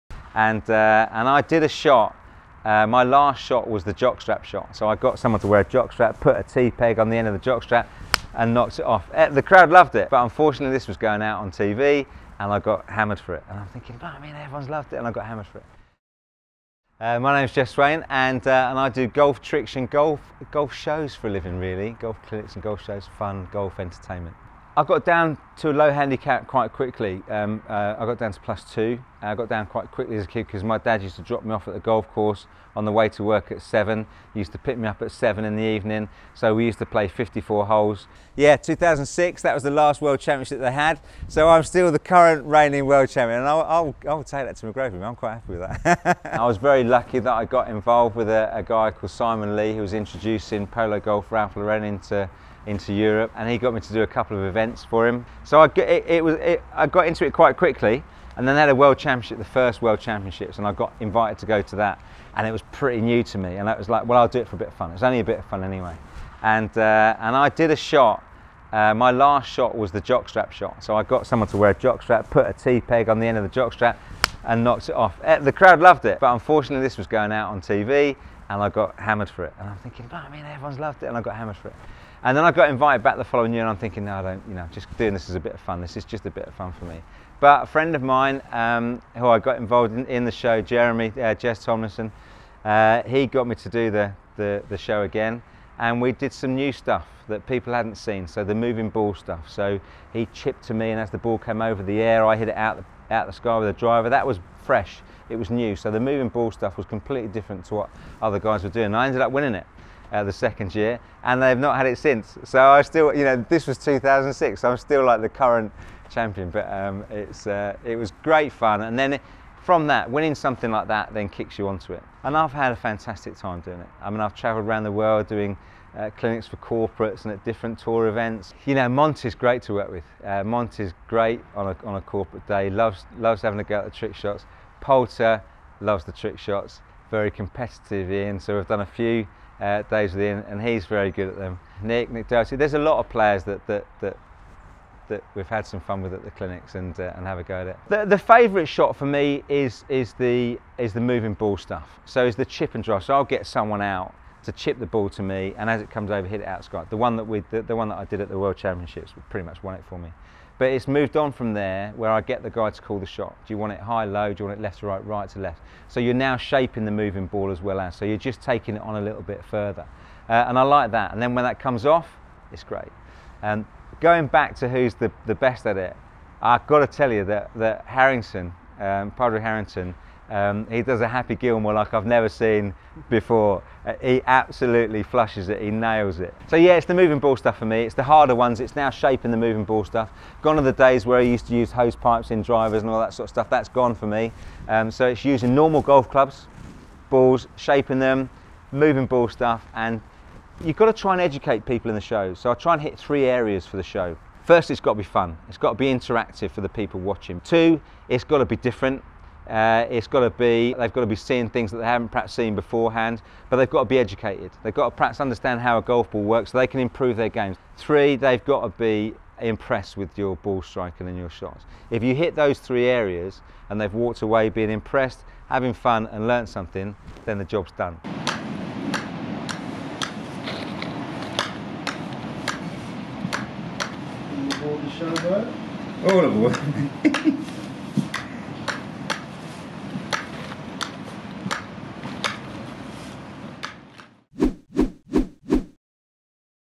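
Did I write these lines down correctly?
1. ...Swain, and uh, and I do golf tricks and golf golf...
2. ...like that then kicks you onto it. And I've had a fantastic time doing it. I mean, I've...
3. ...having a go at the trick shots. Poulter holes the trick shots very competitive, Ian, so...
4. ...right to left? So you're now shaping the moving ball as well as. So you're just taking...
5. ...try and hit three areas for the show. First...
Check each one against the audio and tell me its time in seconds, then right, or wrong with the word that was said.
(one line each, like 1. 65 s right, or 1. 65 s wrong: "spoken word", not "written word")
1. 17 s right
2. 120 s right
3. 133 s wrong: "loves", not "holes"
4. 165 s right
5. 202 s right.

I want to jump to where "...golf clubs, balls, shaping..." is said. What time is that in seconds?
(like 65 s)
195 s.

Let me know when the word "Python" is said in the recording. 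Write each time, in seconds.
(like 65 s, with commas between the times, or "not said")
not said.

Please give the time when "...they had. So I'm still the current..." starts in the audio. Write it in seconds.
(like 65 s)
40 s.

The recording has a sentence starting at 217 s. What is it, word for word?
Three, they've got to be impressed with your ball striking and your shots.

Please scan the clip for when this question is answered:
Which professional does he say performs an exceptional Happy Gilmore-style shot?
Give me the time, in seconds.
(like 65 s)
179 s.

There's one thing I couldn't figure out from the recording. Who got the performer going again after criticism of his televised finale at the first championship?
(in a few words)
Jess Tomlinson.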